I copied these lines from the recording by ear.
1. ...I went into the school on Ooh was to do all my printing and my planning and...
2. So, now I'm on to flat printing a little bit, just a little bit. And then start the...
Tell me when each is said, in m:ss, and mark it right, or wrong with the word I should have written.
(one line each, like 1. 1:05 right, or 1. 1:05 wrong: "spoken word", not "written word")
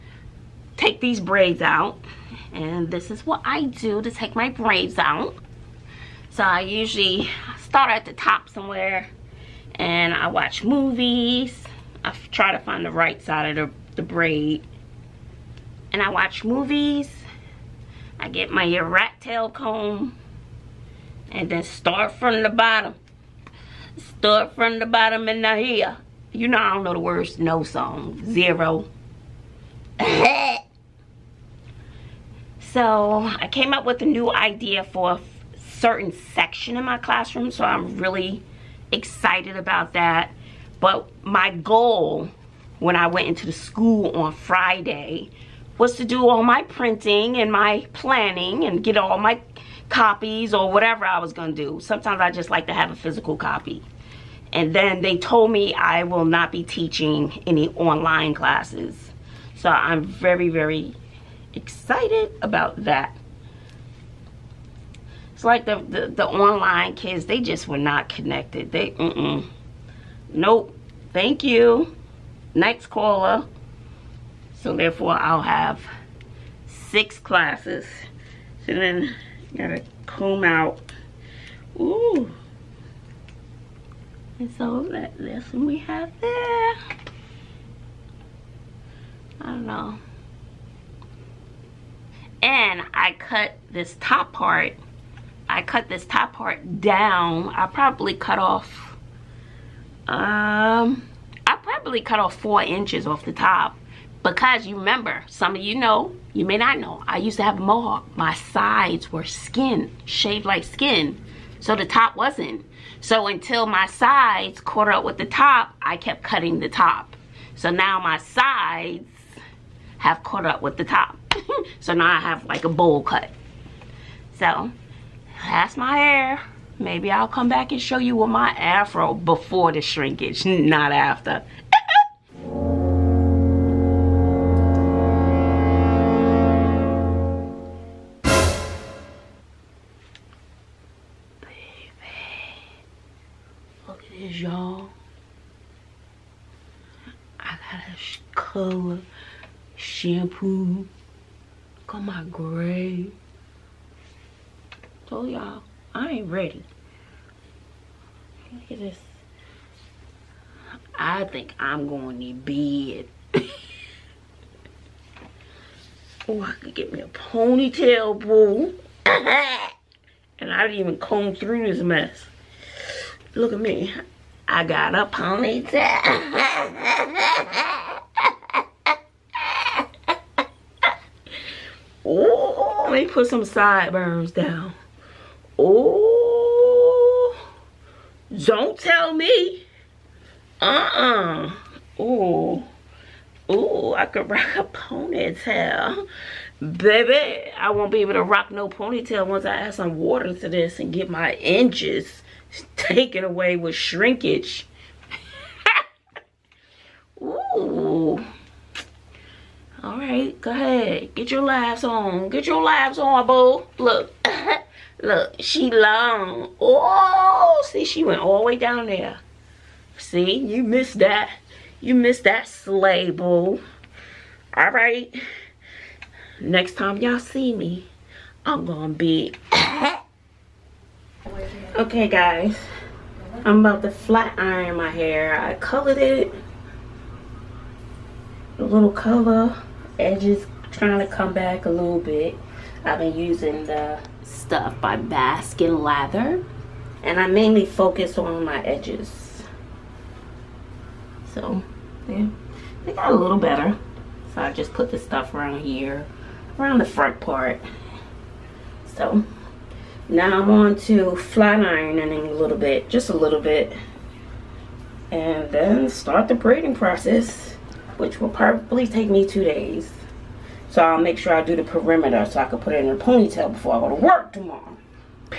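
1. 0:42 wrong: "Friday", not "Ooh"
2. 4:18 wrong: "ironing", not "printing".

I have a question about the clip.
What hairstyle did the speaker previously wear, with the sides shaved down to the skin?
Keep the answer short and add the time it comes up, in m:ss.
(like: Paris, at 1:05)
mohawk, at 1:47.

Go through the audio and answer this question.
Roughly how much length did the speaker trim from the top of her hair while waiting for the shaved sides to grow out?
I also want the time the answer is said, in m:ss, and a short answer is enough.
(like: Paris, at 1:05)
4 inches, at 1:42.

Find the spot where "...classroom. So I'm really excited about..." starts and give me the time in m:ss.
0:36.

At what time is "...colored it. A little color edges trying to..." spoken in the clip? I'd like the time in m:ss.
3:55.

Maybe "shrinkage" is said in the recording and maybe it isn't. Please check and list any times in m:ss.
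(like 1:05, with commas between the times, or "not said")
2:09, 3:23.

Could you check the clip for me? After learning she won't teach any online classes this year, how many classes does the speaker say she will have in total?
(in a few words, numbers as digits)
6.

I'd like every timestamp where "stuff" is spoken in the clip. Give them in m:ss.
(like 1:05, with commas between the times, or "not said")
4:04, 4:14.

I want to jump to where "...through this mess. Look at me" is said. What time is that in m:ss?
2:51.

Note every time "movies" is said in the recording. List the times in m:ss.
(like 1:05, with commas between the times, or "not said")
0:10, 0:16.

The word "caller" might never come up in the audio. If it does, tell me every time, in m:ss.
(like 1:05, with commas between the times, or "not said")
1:12.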